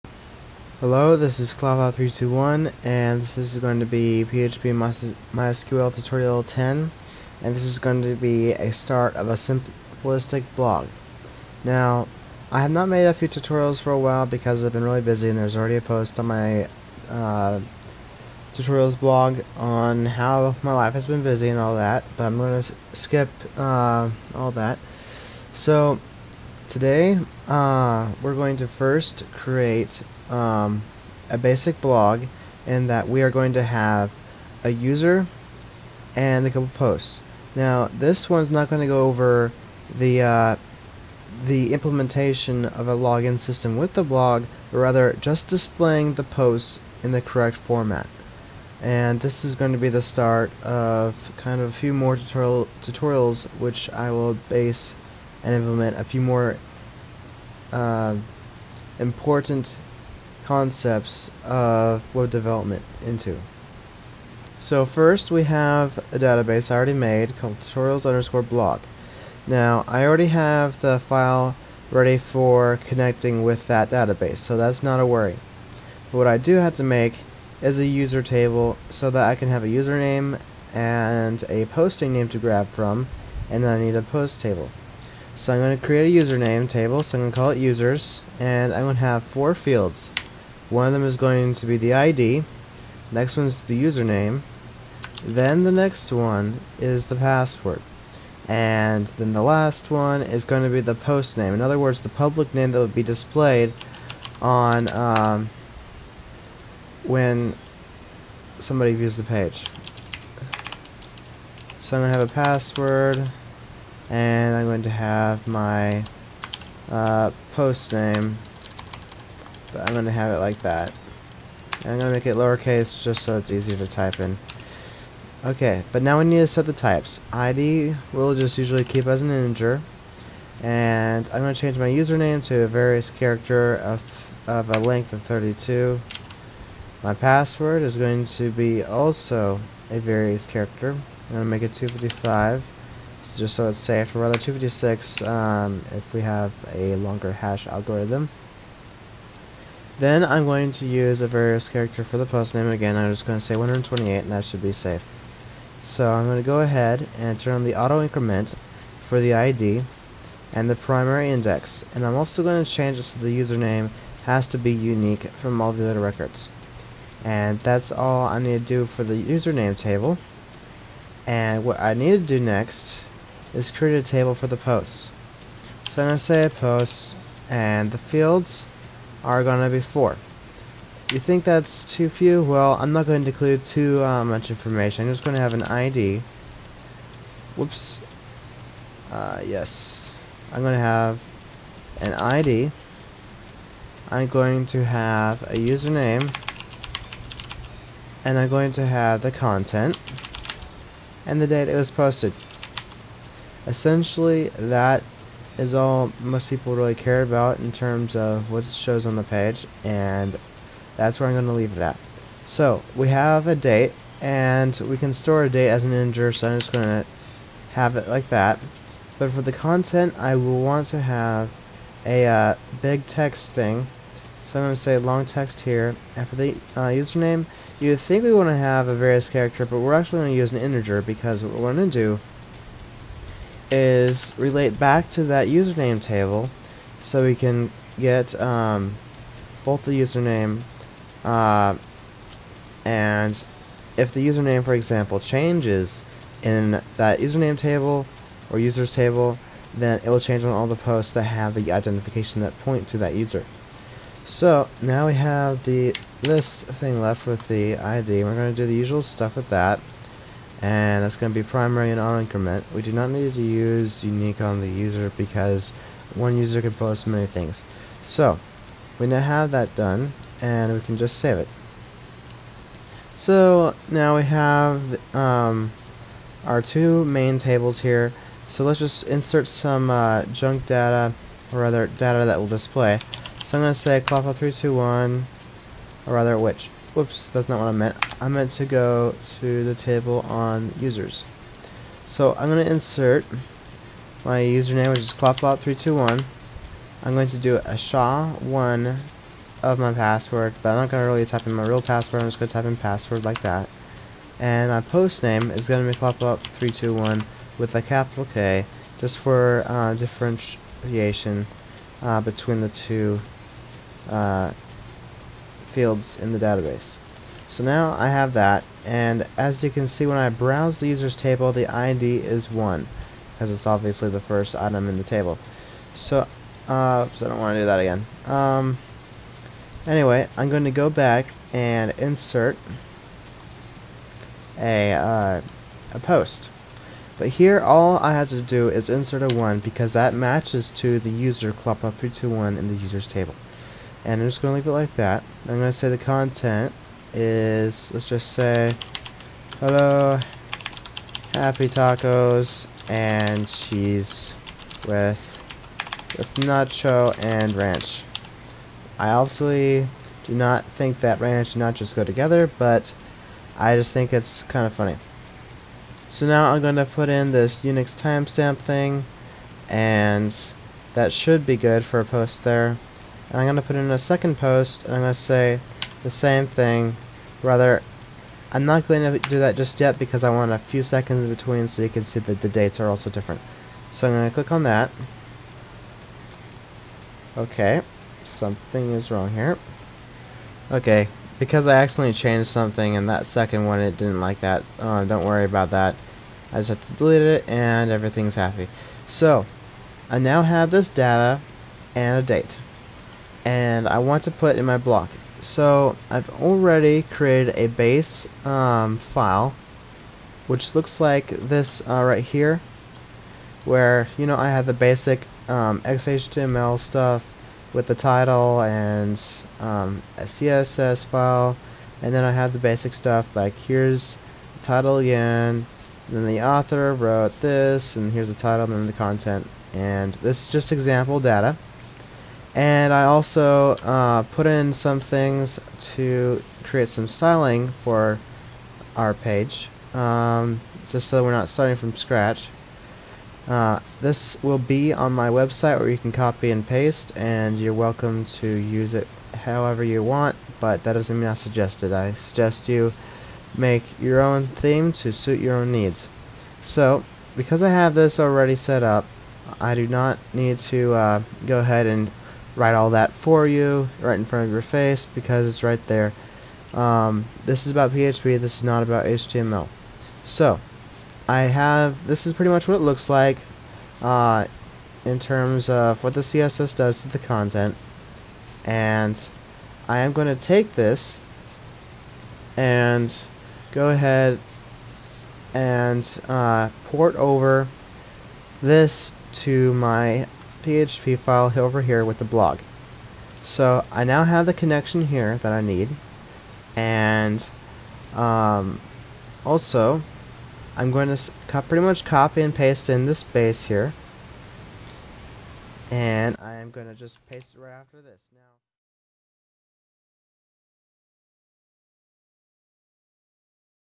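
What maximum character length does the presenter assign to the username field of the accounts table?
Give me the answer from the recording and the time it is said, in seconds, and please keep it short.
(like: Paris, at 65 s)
32, at 135 s.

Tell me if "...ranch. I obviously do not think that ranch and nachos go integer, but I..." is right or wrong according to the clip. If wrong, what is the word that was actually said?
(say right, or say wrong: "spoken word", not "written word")
wrong: "together", not "integer".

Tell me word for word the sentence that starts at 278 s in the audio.
So let's just insert some uh, junk data or rather data that will display.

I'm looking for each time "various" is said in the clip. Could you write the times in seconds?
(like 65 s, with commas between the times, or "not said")
132 s, 139 s, 151 s, 228 s.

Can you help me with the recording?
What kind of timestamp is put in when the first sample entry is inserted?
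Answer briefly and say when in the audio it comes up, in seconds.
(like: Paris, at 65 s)
Unix timestamp, at 367 s.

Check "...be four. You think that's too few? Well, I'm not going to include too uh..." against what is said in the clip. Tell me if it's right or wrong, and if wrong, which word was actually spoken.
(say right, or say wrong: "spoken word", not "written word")
right.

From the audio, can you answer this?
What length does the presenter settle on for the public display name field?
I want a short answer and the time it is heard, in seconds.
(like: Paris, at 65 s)
128, at 153 s.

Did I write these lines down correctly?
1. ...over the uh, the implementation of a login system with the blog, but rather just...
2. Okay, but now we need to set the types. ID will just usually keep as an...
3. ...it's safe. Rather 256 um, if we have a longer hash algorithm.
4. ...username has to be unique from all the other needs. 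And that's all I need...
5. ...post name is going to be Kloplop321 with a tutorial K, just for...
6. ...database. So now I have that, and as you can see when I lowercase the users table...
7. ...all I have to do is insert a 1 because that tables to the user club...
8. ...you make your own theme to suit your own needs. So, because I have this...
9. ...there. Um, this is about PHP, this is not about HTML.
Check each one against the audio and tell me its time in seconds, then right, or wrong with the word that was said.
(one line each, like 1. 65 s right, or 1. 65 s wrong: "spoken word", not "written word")
1. 39 s right
2. 125 s right
3. 143 s right
4. 163 s wrong: "records", not "needs"
5. 304 s wrong: "capital", not "tutorial"
6. 316 s wrong: "browse", not "lowercase"
7. 337 s wrong: "matches", not "tables"
8. 452 s right
9. 465 s right.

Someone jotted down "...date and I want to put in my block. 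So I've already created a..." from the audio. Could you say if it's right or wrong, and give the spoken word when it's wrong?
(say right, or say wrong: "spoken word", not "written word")
right.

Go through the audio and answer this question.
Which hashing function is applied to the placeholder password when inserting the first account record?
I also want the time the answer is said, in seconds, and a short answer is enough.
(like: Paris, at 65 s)
SHA-1, at 297 s.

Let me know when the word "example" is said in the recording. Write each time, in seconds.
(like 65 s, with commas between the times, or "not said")
244 s, 430 s.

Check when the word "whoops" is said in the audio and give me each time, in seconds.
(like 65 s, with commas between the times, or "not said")
187 s, 286 s.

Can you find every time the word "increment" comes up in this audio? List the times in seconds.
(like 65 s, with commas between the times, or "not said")
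158 s, 262 s.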